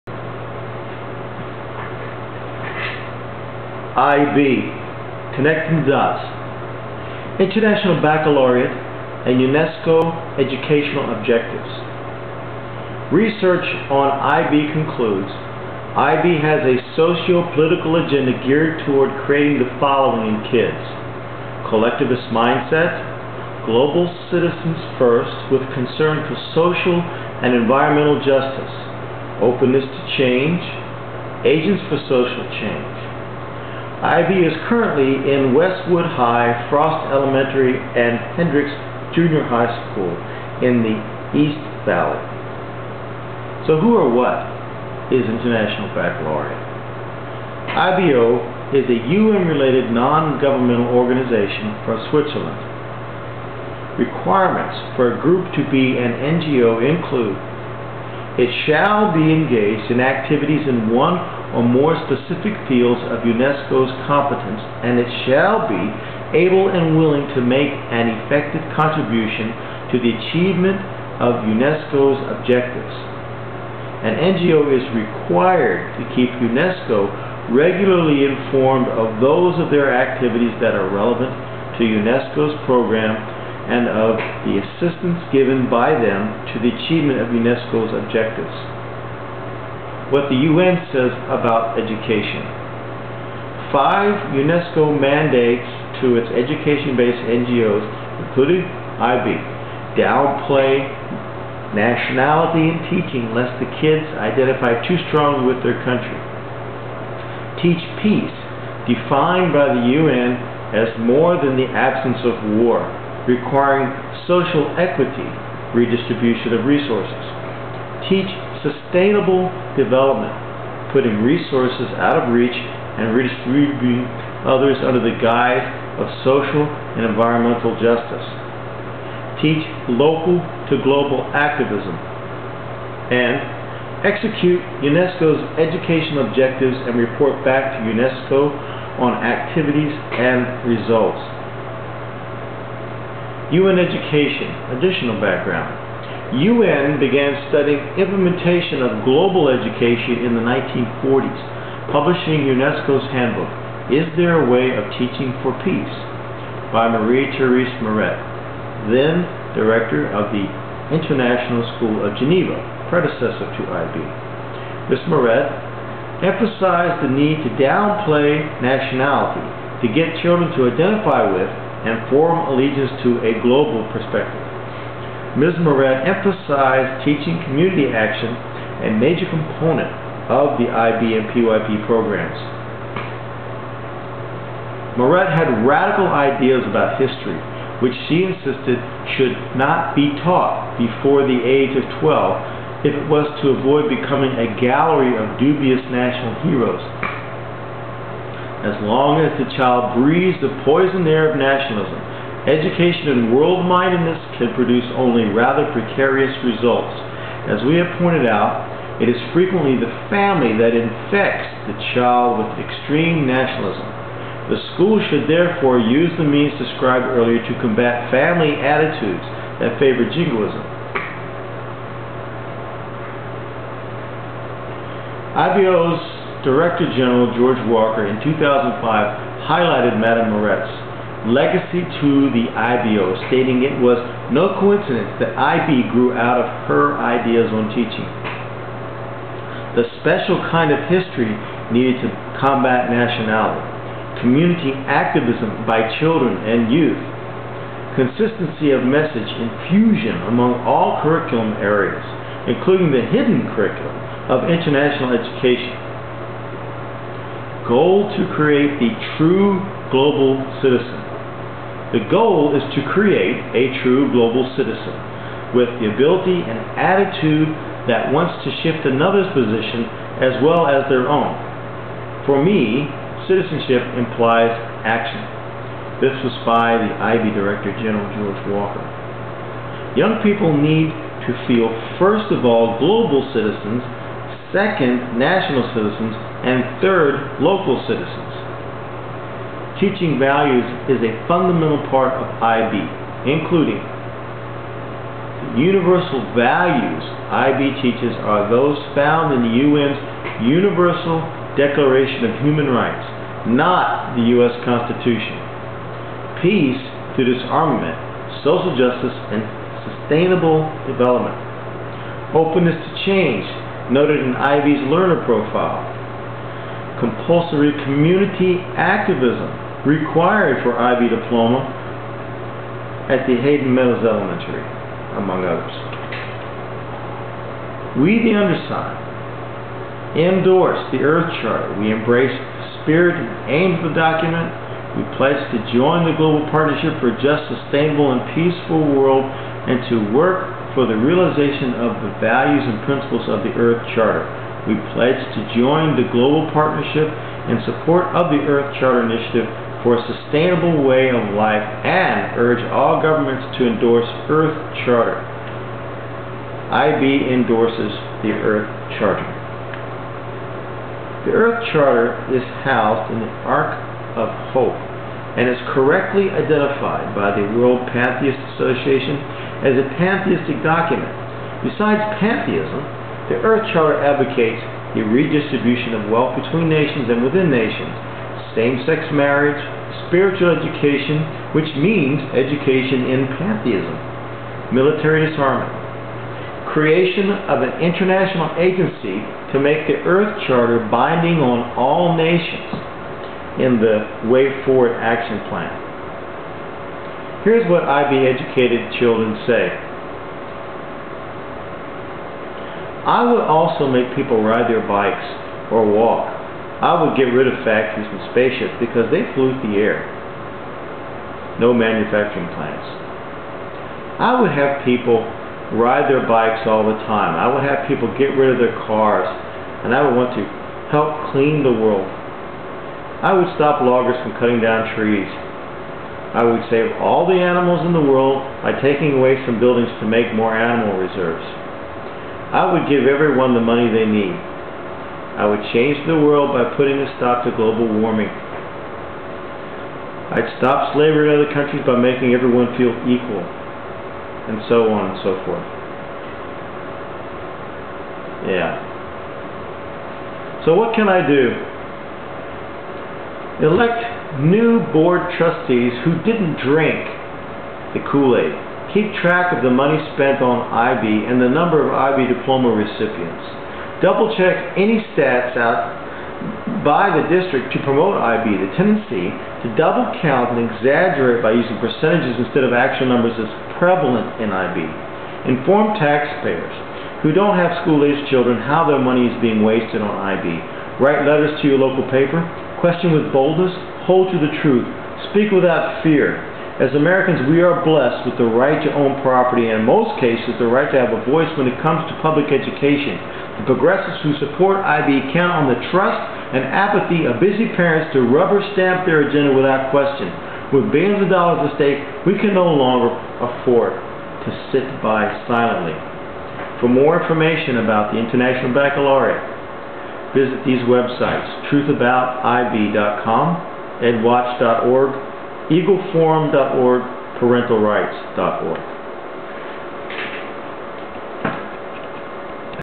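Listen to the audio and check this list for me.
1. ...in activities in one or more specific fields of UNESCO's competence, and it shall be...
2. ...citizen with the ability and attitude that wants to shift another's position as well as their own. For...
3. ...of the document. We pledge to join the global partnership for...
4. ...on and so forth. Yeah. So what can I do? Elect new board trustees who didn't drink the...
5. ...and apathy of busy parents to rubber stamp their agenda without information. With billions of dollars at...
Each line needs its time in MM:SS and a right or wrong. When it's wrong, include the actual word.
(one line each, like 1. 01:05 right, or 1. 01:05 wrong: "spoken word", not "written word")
1. 00:59 right
2. 04:24 right
3. 05:33 right
4. 07:24 right
5. 08:16 wrong: "question", not "information".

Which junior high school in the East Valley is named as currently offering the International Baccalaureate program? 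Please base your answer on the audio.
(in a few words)
Hendrix Junior High School.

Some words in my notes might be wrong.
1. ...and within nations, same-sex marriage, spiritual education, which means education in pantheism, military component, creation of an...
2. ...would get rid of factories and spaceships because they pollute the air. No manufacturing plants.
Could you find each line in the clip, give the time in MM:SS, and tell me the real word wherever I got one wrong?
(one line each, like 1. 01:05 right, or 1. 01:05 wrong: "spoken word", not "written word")
1. 06:17 wrong: "disarmament", not "component"
2. 06:47 right.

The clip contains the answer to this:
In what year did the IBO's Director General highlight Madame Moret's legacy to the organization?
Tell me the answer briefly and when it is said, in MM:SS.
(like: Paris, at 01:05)
2005, at 03:48.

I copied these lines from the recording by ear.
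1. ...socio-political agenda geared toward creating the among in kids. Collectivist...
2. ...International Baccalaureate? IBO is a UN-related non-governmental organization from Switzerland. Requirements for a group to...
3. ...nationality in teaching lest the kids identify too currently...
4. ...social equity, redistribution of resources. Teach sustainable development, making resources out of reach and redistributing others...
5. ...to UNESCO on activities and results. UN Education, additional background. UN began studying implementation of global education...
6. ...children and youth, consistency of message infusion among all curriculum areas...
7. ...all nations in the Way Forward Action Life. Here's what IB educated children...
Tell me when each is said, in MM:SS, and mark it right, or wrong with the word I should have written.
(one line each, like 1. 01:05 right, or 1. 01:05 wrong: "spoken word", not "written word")
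1. 00:16 wrong: "following", not "among"
2. 00:45 right
3. 01:41 wrong: "strongly", not "currently"
4. 01:54 wrong: "putting", not "making"
5. 02:17 right
6. 04:06 right
7. 06:31 wrong: "Plan", not "Life".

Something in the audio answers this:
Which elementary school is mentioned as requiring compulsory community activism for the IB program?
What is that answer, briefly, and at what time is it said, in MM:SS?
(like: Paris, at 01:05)
Hayden Meadows Elementary, at 05:23.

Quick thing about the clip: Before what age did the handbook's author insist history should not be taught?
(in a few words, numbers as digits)
12.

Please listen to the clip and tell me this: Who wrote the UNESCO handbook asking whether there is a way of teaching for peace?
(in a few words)
Marie-Therese Moret.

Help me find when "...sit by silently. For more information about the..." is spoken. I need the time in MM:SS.
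08:24.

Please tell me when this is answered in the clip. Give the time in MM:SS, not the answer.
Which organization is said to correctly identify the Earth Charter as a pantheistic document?
06:07.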